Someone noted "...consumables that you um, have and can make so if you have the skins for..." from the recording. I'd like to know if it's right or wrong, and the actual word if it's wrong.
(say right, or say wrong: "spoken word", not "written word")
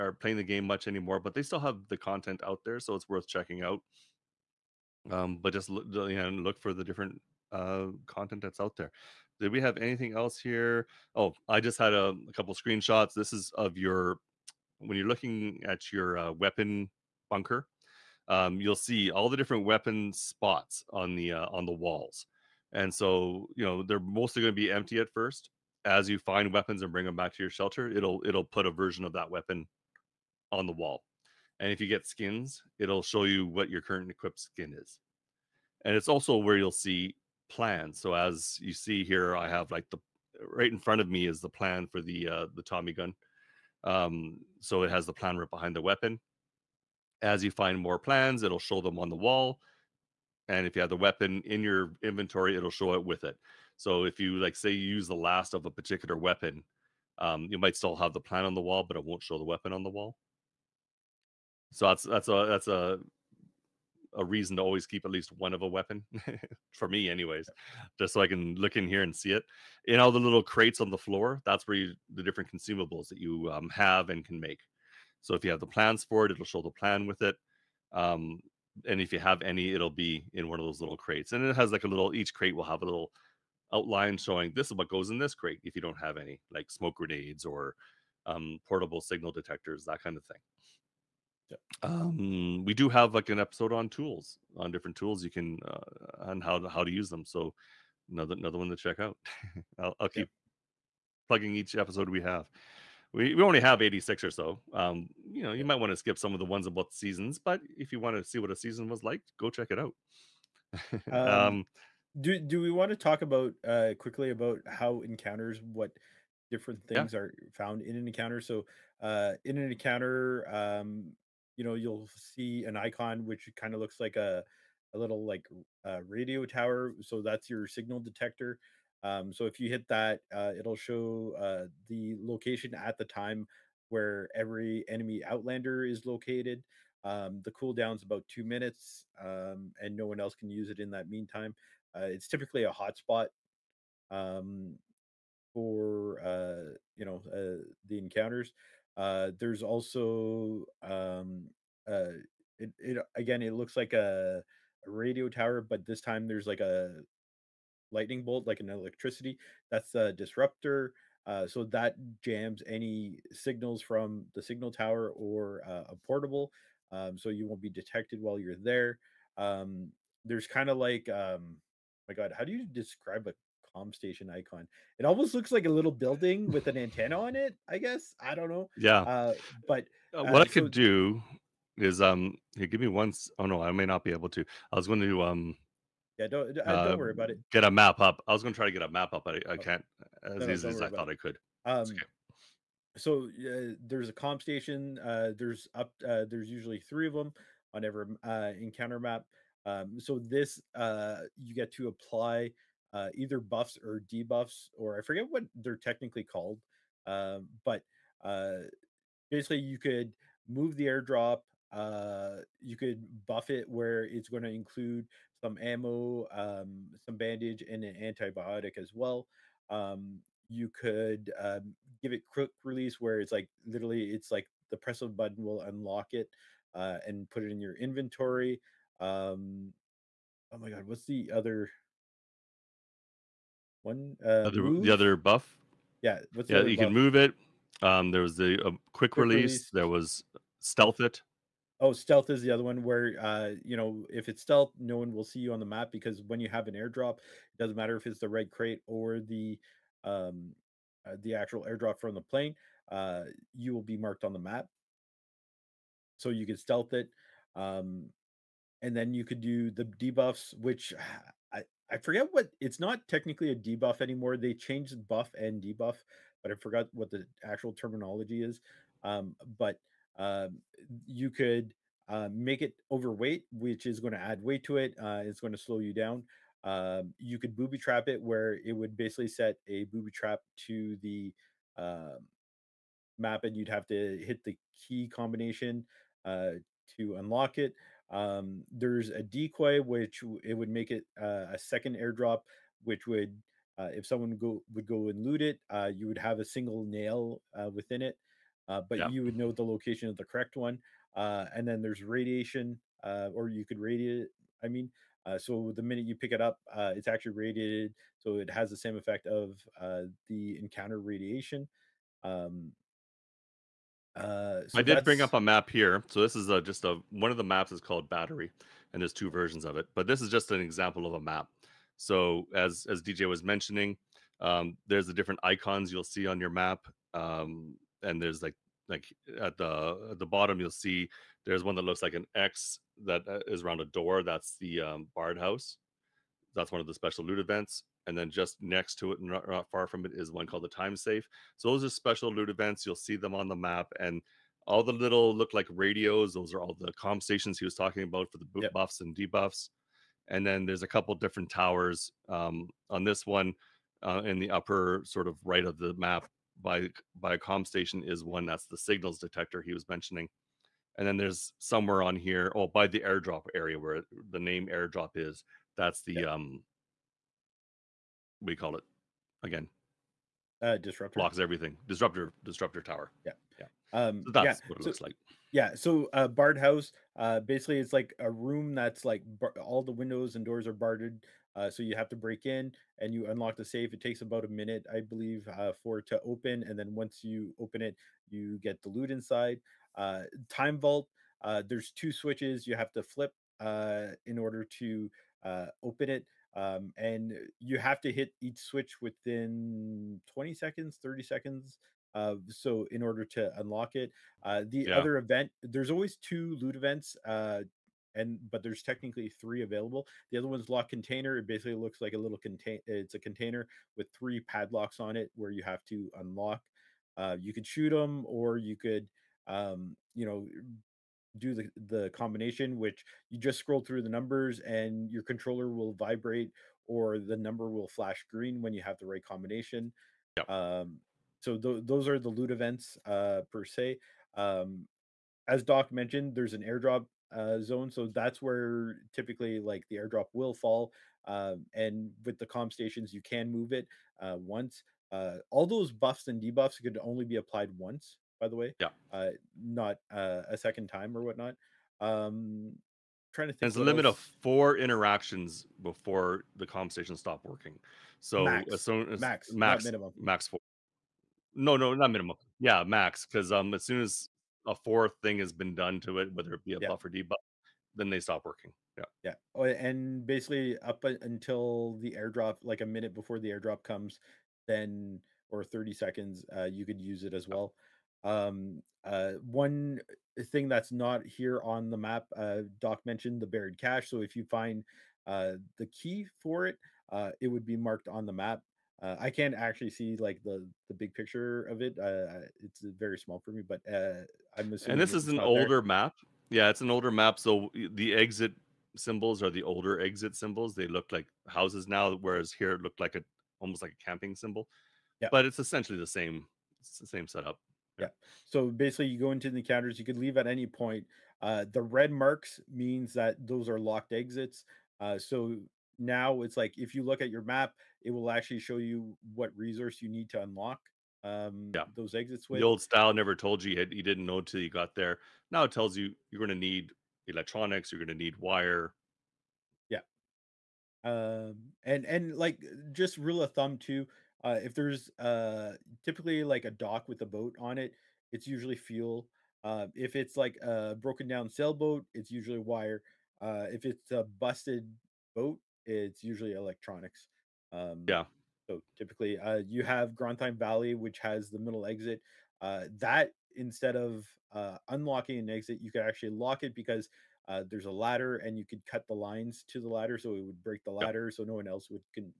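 wrong: "plans", not "skins".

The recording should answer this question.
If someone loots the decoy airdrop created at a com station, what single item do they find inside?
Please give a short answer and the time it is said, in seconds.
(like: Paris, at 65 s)
A single nail, at 296 s.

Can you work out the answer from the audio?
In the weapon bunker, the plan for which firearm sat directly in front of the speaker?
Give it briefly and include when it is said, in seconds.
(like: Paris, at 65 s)
Tommy gun, at 42 s.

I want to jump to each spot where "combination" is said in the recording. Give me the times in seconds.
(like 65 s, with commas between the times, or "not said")
285 s, 422 s, 429 s.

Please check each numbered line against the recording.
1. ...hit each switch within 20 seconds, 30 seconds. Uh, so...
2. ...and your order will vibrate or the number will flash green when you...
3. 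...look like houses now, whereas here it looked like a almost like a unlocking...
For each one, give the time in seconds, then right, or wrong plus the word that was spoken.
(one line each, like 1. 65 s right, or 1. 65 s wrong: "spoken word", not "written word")
1. 398 s right
2. 424 s wrong: "controller", not "order"
3. 500 s wrong: "camping", not "unlocking".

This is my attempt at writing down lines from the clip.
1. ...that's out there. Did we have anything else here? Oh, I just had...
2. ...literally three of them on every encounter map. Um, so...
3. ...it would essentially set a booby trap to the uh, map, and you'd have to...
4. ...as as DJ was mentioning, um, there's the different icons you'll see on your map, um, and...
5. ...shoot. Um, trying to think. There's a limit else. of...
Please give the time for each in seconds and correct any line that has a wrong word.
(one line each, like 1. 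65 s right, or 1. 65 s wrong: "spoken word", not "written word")
1. 8 s right
2. 196 s wrong: "usually", not "literally"
3. 278 s wrong: "basically", not "essentially"
4. 322 s right
5. 451 s wrong: "whatnot", not "shoot".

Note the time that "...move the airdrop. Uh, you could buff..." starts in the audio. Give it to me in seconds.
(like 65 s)
210 s.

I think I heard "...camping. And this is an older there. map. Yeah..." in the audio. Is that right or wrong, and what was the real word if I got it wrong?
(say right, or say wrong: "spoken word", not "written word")
wrong: "assuming", not "camping".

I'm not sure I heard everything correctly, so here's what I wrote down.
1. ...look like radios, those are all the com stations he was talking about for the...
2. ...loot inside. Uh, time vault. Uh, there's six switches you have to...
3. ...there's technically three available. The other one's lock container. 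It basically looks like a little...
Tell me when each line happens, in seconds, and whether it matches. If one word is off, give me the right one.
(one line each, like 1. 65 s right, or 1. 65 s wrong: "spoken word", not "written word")
1. 345 s right
2. 388 s wrong: "two", not "six"
3. 408 s right.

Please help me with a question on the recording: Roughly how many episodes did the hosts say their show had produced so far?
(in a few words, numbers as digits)
86.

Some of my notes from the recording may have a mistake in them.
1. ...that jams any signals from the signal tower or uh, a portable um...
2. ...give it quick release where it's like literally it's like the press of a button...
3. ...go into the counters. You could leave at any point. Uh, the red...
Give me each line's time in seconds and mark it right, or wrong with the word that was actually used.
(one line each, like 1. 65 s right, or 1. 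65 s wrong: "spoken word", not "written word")
1. 161 s right
2. 222 s right
3. 509 s right.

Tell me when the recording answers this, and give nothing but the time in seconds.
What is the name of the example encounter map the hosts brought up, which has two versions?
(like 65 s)
318 s.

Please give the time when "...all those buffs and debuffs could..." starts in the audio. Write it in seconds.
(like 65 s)
445 s.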